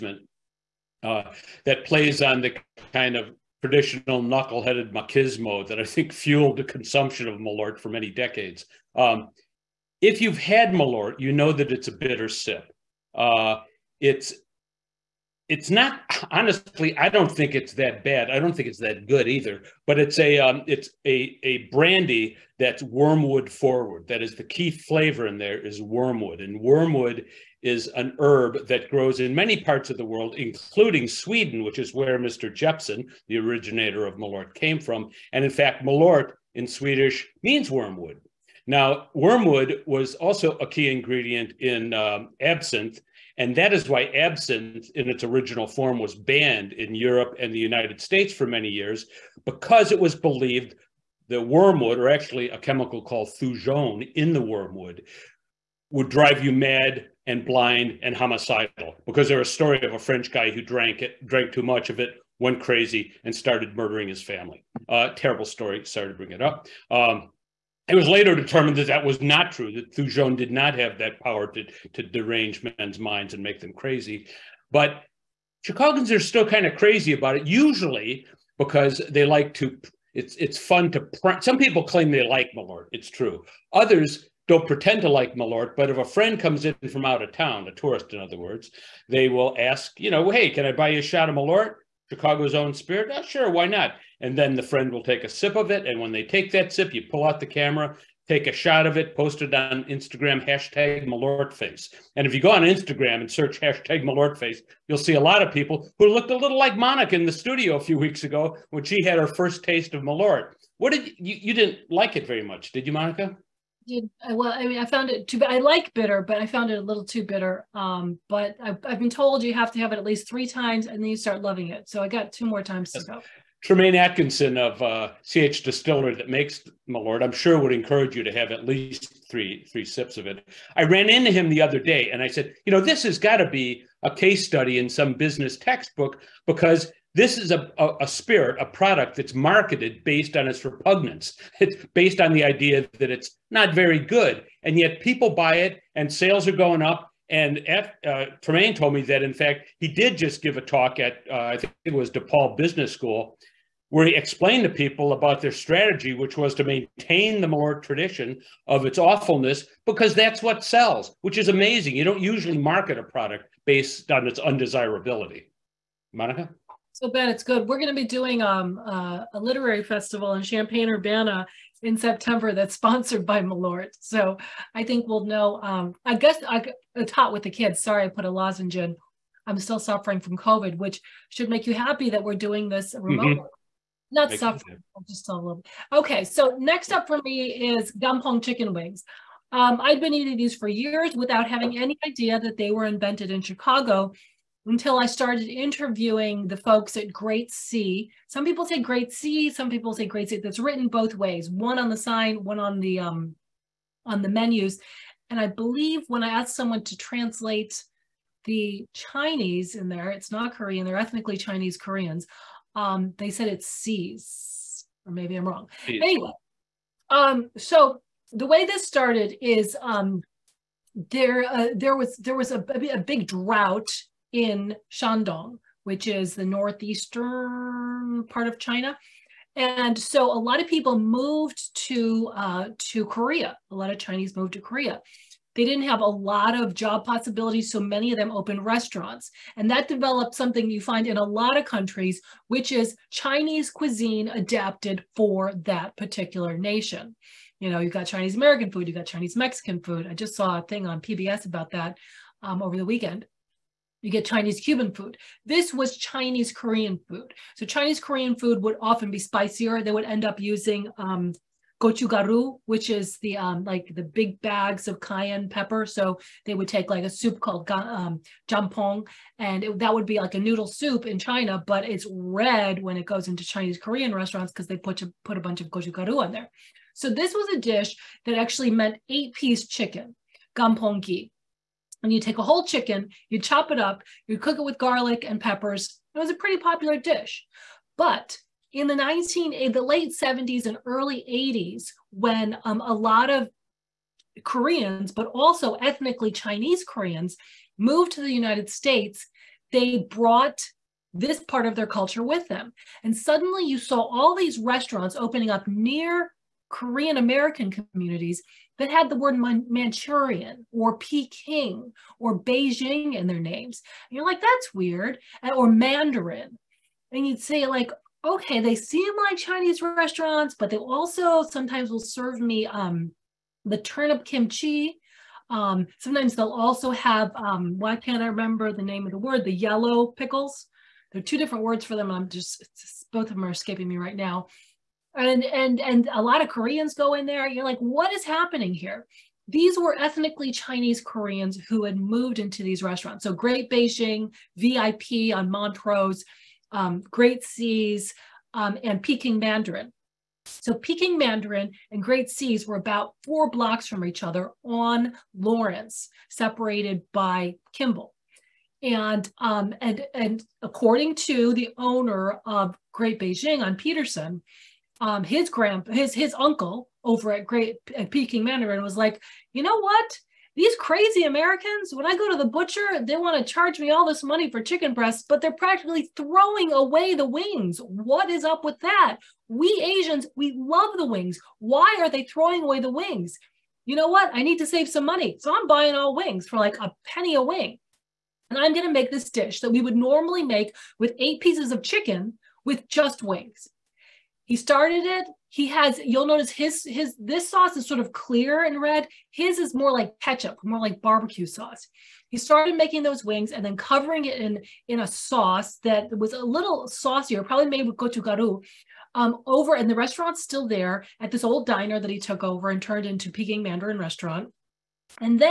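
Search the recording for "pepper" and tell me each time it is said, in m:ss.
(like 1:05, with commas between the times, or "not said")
4:25, 4:45.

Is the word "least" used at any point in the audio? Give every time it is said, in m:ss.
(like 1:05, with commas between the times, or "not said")
2:00, 2:08.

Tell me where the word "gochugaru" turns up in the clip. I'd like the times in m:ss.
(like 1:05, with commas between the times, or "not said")
4:21, 4:35, 6:47.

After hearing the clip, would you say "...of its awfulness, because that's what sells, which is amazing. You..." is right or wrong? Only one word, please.
right.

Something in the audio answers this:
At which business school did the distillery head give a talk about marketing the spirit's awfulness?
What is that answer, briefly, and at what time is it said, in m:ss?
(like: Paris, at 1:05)
DePaul Business School, at 2:32.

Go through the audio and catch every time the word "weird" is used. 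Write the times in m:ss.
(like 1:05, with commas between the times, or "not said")
5:14.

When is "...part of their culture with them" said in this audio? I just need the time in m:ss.
5:01.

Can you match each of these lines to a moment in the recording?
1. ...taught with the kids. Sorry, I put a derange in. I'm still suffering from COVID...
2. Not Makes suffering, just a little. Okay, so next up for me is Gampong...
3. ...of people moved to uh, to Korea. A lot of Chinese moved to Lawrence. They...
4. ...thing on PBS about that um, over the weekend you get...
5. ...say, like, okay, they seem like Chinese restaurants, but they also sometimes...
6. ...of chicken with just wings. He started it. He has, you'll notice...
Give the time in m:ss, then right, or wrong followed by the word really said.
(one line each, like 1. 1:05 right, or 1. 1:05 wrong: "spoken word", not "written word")
1. 2:57 wrong: "lozenge", not "derange"
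2. 3:04 right
3. 3:50 wrong: "Korea", not "Lawrence"
4. 4:10 right
5. 5:17 right
6. 6:31 right.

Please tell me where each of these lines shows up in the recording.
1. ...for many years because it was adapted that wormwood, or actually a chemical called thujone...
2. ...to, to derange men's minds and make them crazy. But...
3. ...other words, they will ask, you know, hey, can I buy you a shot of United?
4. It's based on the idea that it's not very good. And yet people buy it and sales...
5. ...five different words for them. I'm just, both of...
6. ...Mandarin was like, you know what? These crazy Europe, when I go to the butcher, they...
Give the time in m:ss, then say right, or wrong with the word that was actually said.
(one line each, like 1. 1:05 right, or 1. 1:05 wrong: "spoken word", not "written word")
1. 0:48 wrong: "believed", not "adapted"
2. 1:11 right
3. 1:28 wrong: "Malort", not "United"
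4. 2:21 right
5. 5:31 wrong: "two", not "five"
6. 6:08 wrong: "Americans", not "Europe".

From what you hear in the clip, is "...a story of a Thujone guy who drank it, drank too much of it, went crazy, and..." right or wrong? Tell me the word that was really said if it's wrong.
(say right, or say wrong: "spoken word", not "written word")
wrong: "French", not "Thujone".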